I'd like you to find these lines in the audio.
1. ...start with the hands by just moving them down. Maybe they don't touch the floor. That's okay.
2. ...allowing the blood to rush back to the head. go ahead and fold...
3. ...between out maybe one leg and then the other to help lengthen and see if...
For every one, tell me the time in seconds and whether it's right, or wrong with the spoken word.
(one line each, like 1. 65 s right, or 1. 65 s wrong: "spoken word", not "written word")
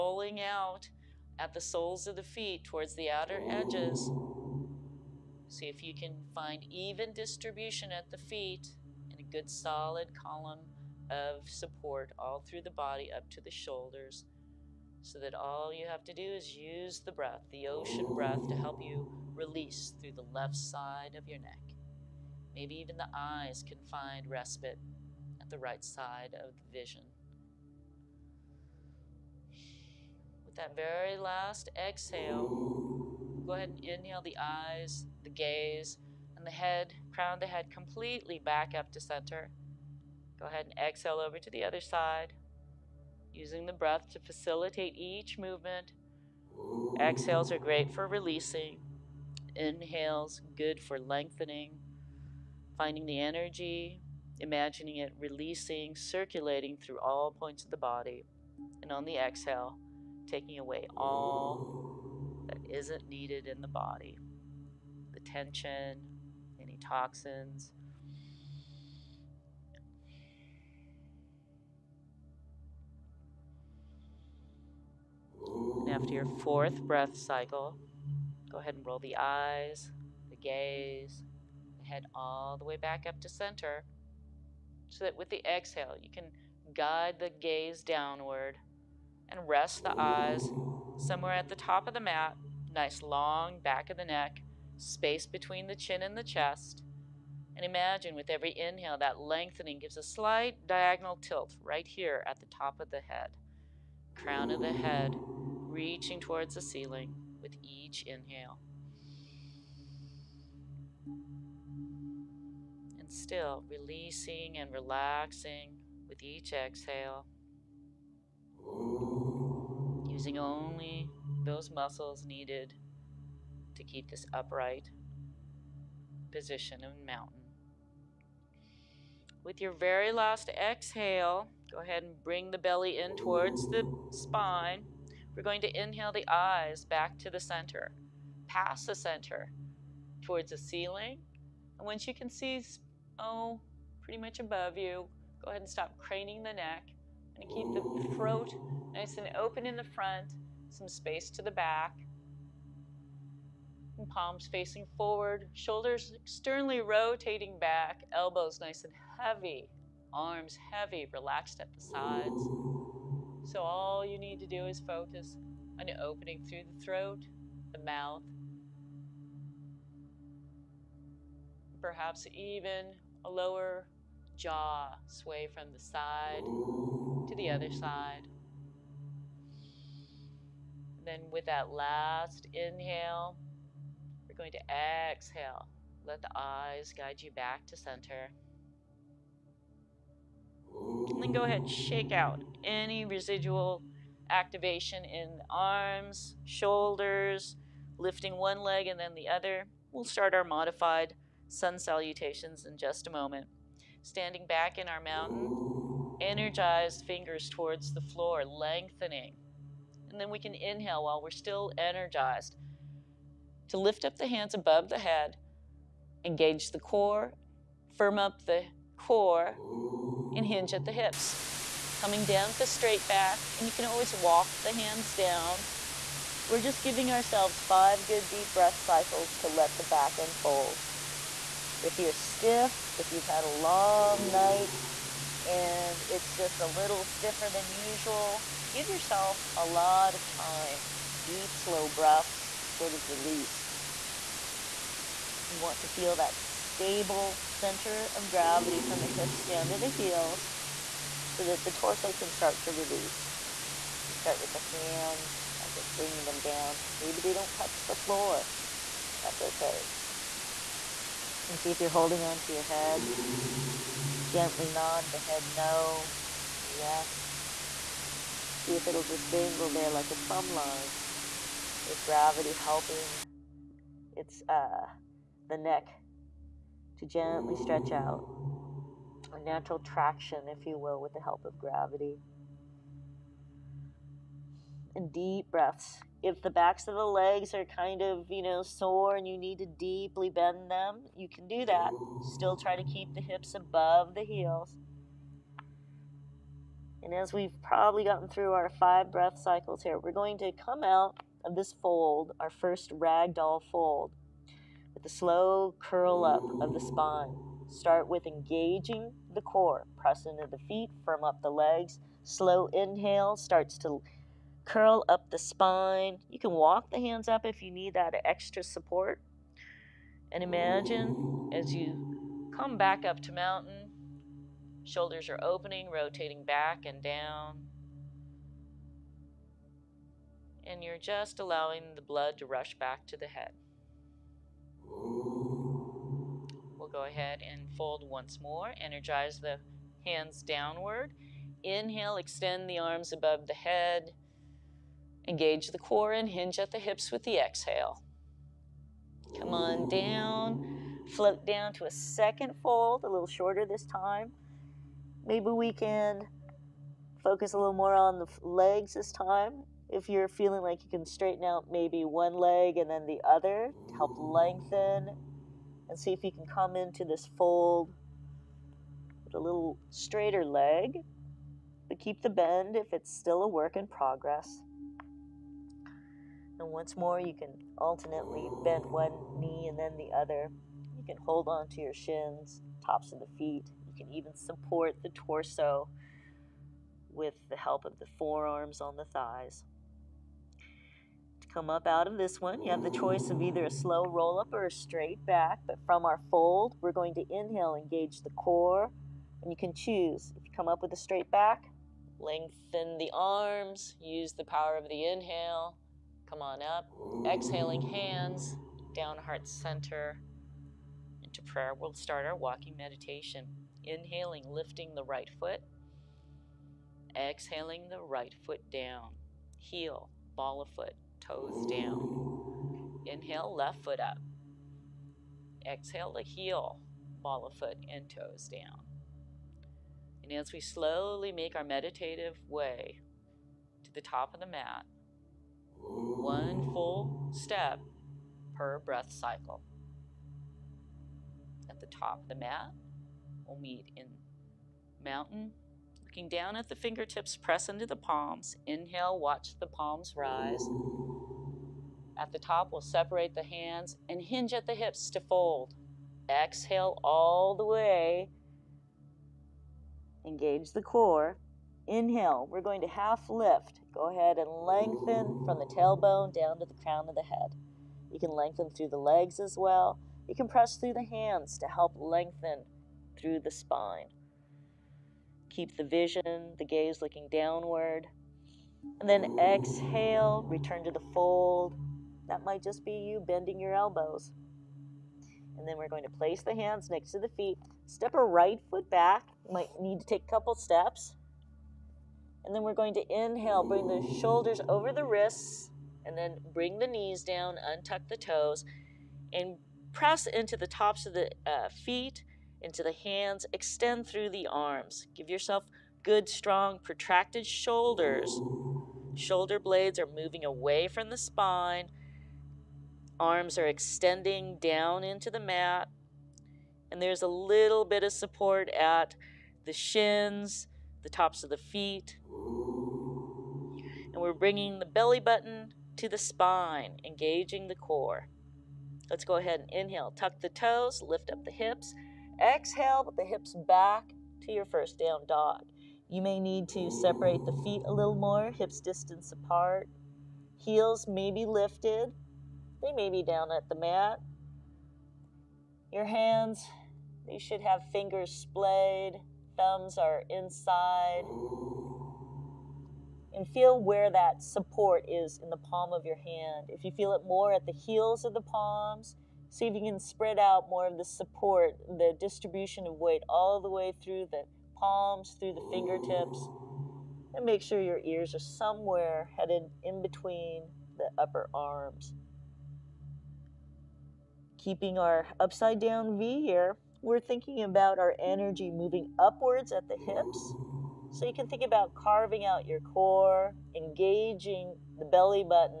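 1. 254 s wrong: "bringing", not "moving"
2. 331 s right
3. 361 s wrong: "straighten", not "between".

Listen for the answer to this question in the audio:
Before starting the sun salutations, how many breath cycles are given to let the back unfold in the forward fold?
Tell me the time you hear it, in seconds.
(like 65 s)
227 s.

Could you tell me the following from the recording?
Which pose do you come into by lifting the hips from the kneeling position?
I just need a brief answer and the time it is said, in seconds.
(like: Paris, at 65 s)
down dog, at 534 s.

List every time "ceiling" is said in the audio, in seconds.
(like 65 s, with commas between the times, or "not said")
106 s, 140 s.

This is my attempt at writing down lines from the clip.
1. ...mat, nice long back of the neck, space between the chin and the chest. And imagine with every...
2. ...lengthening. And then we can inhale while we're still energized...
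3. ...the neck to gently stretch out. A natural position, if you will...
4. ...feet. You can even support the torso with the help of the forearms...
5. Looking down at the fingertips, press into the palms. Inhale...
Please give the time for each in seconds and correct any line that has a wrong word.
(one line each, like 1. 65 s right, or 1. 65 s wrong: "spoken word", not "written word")
1. 91 s right
2. 208 s right
3. 275 s wrong: "traction", not "position"
4. 383 s right
5. 446 s right.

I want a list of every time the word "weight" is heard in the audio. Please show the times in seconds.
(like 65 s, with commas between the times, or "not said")
562 s.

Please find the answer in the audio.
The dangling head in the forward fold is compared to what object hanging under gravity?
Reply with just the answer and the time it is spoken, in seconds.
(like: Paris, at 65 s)
a plumb line, at 270 s.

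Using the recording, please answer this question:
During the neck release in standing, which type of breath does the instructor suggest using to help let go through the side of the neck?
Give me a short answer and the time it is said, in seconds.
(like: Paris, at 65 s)
ocean breath, at 17 s.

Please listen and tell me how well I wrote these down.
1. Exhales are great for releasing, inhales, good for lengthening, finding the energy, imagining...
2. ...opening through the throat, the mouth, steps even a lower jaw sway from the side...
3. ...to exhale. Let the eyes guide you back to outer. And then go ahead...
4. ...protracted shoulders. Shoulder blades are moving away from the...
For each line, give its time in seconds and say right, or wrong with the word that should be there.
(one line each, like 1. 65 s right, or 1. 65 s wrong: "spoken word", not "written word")
1. 46 s right
2. 165 s wrong: "perhaps", not "steps"
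3. 184 s wrong: "center", not "outer"
4. 506 s right.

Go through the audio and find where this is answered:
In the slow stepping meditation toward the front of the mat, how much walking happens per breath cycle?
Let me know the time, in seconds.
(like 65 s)
435 s.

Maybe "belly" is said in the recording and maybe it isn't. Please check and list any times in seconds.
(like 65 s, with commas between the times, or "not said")
132 s, 524 s, 585 s.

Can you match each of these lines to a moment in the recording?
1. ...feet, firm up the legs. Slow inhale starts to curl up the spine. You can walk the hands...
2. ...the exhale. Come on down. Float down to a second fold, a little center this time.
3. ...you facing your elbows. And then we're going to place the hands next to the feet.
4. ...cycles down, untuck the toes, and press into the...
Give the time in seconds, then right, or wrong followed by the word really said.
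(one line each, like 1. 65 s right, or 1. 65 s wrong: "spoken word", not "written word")
1. 310 s right
2. 347 s wrong: "shorter", not "center"
3. 482 s wrong: "bending", not "facing"
4. 496 s wrong: "knees", not "cycles".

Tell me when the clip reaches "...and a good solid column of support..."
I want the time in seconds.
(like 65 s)
9 s.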